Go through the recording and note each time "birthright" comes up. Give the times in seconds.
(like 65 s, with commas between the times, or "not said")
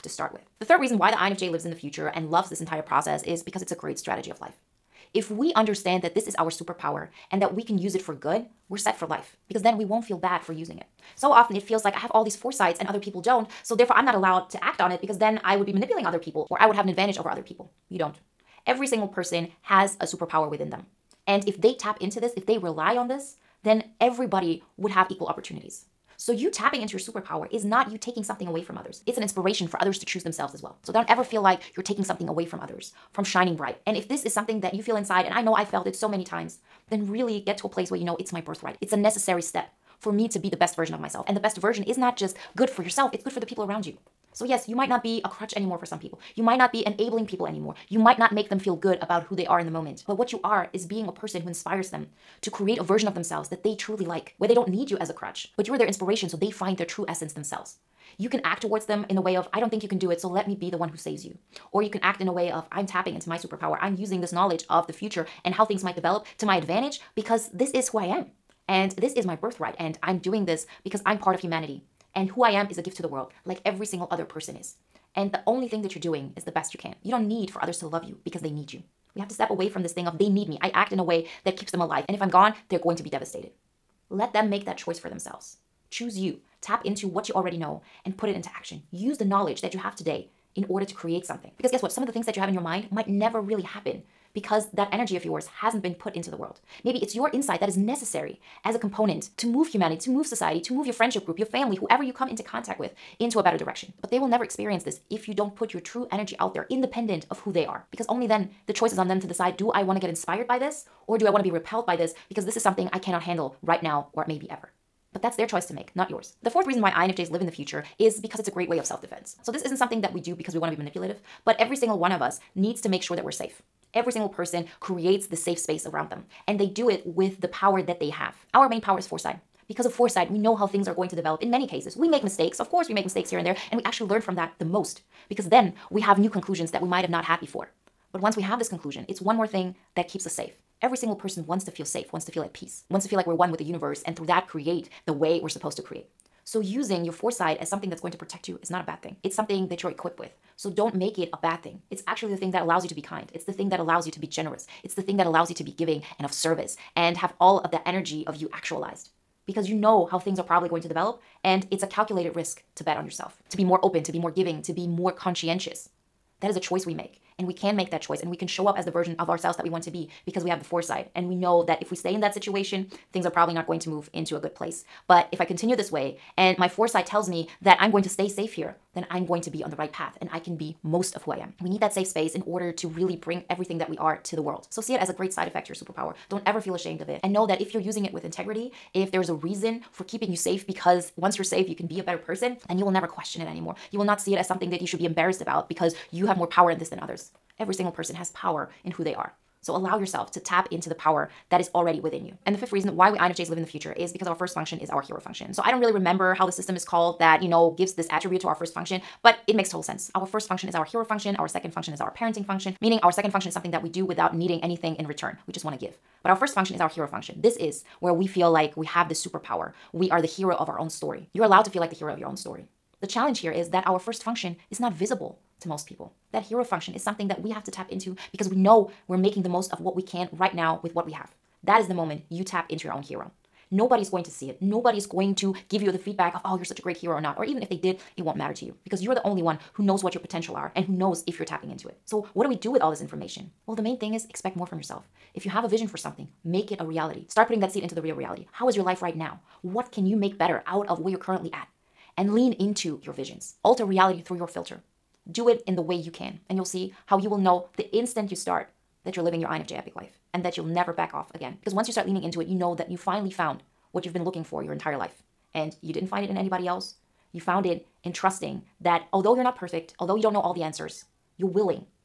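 38 s, 69 s.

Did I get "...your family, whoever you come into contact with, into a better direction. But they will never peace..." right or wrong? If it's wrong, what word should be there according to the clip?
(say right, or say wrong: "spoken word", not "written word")
wrong: "experience", not "peace".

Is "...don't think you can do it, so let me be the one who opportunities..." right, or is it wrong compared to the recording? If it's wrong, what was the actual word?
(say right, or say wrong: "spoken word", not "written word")
wrong: "saves", not "opportunities".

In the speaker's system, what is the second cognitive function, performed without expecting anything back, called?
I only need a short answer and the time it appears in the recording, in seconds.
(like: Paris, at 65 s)
Parenting function, at 212 s.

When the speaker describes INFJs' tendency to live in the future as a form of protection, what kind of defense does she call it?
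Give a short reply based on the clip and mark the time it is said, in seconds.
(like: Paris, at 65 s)
Self defense, at 118 s.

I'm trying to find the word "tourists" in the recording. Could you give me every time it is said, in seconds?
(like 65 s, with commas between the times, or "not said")
not said.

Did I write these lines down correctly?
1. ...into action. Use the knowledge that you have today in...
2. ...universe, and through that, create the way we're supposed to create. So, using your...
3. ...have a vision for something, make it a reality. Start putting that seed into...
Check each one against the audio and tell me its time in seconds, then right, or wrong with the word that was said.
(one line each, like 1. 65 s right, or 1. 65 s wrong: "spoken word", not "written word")
1. 88 s right
2. 143 s right
3. 245 s right.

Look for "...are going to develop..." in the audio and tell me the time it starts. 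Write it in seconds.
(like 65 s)
130 s.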